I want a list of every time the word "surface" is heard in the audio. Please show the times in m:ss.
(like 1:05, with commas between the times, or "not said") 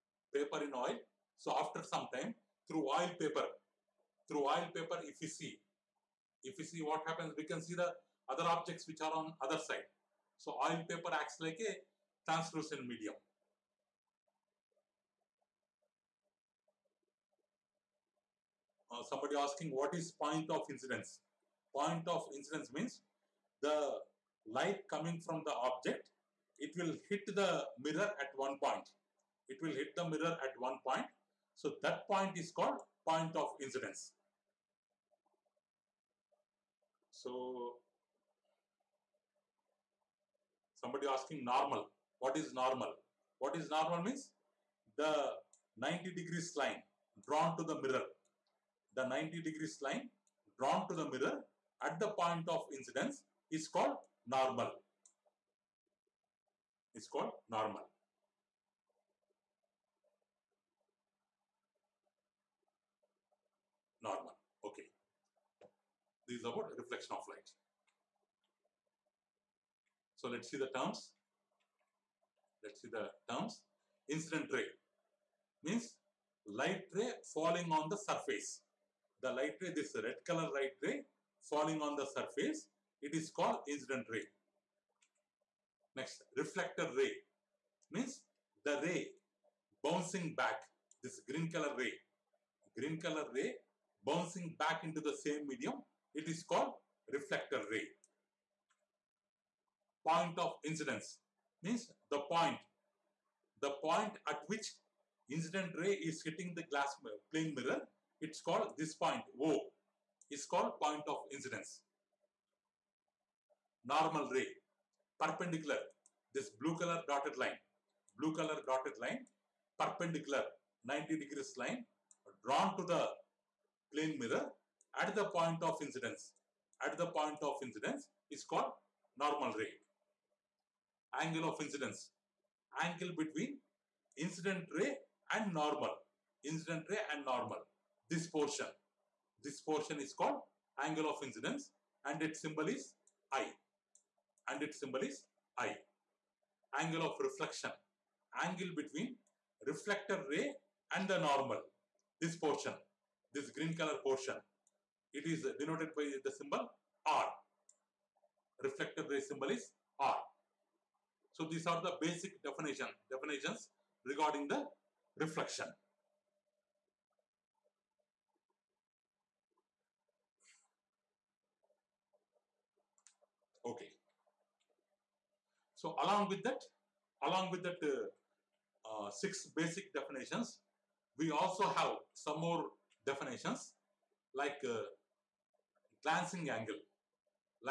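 1:17, 1:22.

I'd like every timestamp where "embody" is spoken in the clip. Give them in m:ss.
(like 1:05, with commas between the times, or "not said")
not said.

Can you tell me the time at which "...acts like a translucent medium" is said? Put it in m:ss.
0:11.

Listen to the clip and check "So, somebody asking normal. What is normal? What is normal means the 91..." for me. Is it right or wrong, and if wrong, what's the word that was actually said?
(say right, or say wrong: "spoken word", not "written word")
wrong: "90", not "91".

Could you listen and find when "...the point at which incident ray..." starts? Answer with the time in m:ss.
1:43.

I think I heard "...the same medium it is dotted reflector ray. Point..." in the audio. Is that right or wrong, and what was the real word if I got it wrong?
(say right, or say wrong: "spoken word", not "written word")
wrong: "called", not "dotted".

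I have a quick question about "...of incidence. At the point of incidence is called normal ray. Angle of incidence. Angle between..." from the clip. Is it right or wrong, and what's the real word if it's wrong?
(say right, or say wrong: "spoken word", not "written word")
right.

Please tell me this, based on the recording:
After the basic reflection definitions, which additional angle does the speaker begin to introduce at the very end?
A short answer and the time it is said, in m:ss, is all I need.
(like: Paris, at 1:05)
Glancing angle, at 3:06.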